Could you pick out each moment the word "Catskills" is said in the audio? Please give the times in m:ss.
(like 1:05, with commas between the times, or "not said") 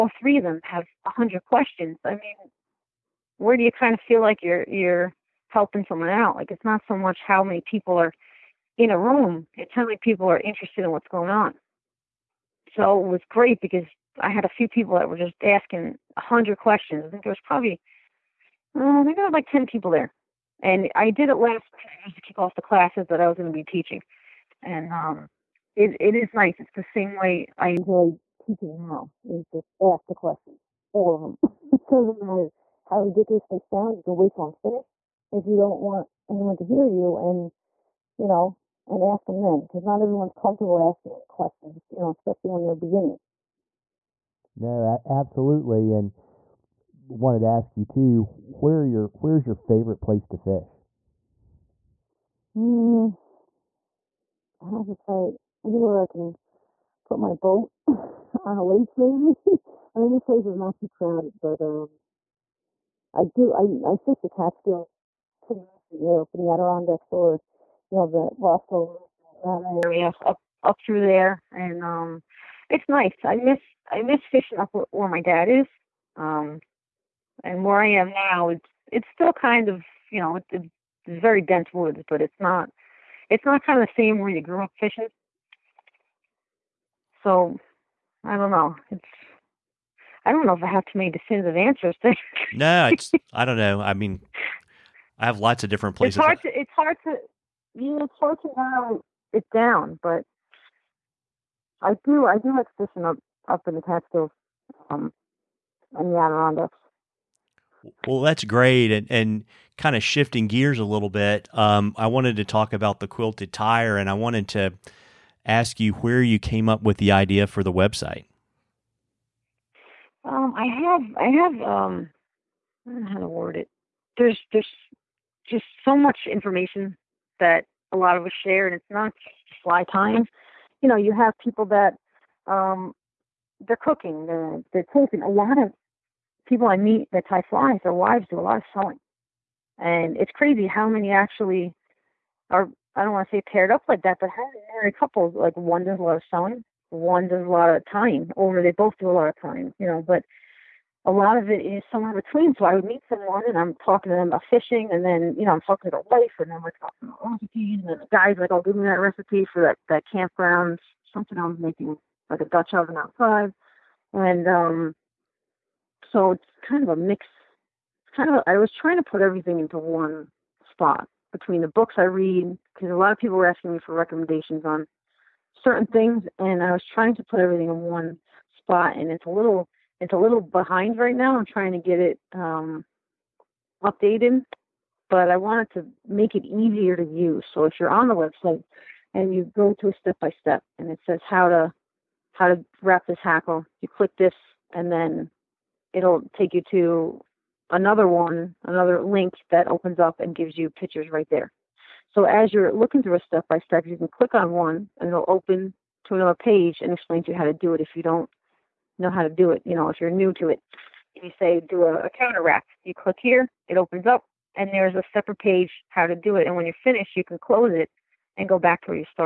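1:04, 1:43.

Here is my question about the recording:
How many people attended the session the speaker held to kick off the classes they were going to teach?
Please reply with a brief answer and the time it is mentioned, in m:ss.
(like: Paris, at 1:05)
10, at 0:19.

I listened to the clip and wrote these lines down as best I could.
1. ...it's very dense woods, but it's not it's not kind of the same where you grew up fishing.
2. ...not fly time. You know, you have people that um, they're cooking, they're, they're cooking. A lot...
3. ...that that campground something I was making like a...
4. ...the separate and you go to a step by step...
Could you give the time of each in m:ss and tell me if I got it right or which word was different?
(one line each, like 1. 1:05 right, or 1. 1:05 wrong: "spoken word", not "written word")
1. 1:20 right
2. 2:08 right
3. 2:39 right
4. 3:08 wrong: "website", not "separate".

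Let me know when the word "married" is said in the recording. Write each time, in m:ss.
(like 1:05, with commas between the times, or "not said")
2:24.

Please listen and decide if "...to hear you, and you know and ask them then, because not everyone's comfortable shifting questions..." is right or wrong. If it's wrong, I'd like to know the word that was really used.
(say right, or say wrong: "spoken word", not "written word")
wrong: "asking", not "shifting".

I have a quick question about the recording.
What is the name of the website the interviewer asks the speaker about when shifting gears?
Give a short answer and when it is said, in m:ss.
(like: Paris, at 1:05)
The Quilted Tyer, at 1:52.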